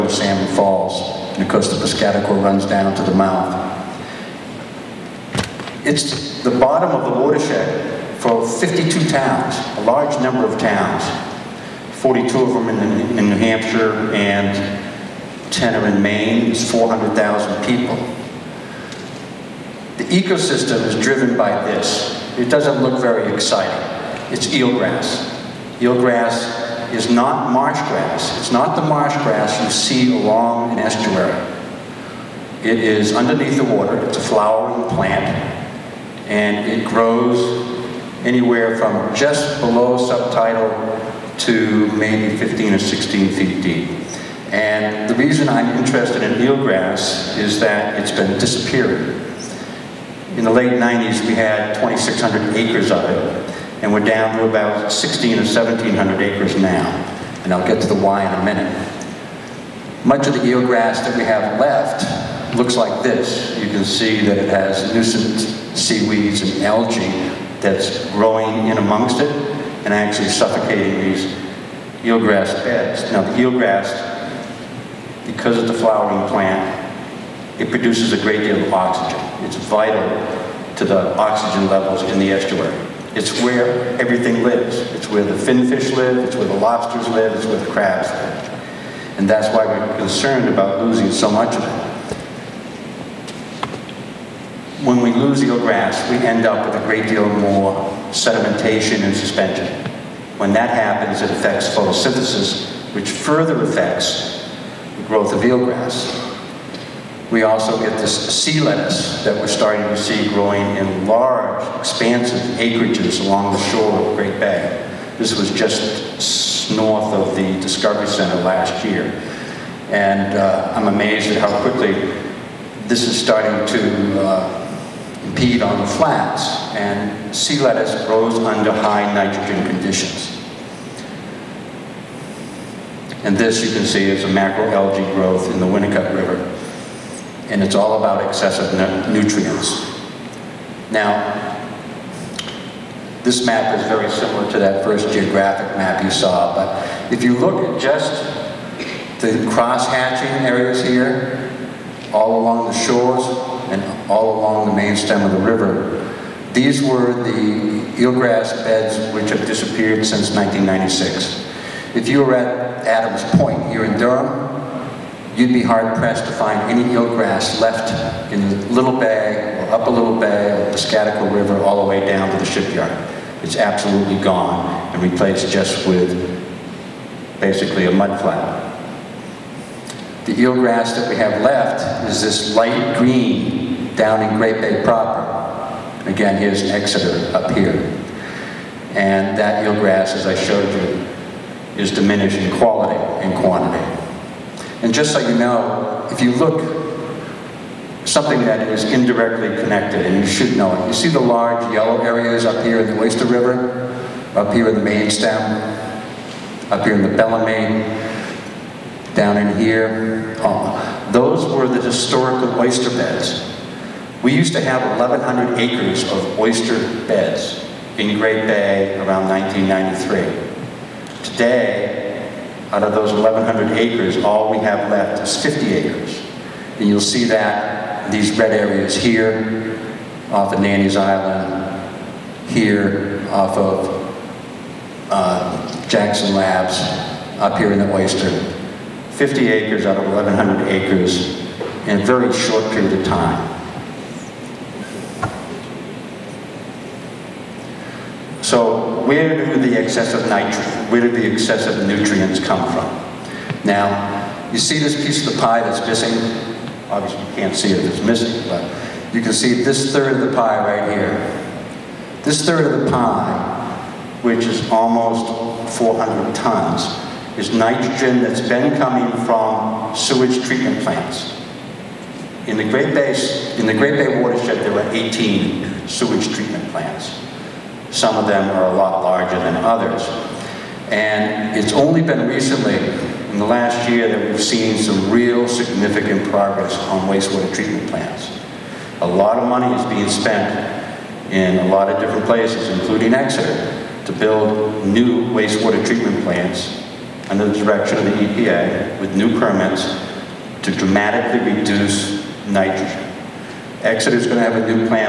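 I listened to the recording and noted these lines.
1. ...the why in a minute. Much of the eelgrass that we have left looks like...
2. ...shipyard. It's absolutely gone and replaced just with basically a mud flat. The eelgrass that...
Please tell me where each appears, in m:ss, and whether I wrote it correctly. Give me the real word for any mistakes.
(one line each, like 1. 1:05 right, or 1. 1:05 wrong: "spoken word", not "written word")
1. 0:57 right
2. 2:52 right.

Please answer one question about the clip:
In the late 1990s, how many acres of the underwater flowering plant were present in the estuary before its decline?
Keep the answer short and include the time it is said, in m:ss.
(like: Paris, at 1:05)
2,600 acres, at 0:51.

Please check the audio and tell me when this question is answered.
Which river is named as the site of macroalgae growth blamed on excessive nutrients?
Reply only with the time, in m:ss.
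2:15.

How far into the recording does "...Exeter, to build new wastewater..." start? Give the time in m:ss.
4:53.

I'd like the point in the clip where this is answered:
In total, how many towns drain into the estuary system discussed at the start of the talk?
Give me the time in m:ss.
0:08.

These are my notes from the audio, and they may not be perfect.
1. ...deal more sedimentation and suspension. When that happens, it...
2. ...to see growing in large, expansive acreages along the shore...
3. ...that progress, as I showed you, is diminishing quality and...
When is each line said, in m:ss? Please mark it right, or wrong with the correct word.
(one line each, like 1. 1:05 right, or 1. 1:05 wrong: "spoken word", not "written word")
1. 1:37 right
2. 1:49 right
3. 3:09 wrong: "eelgrass", not "progress".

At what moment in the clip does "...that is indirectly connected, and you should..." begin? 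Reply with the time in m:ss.
3:18.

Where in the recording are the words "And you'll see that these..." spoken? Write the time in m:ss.
3:46.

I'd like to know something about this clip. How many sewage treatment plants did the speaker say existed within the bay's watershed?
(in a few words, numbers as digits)
18.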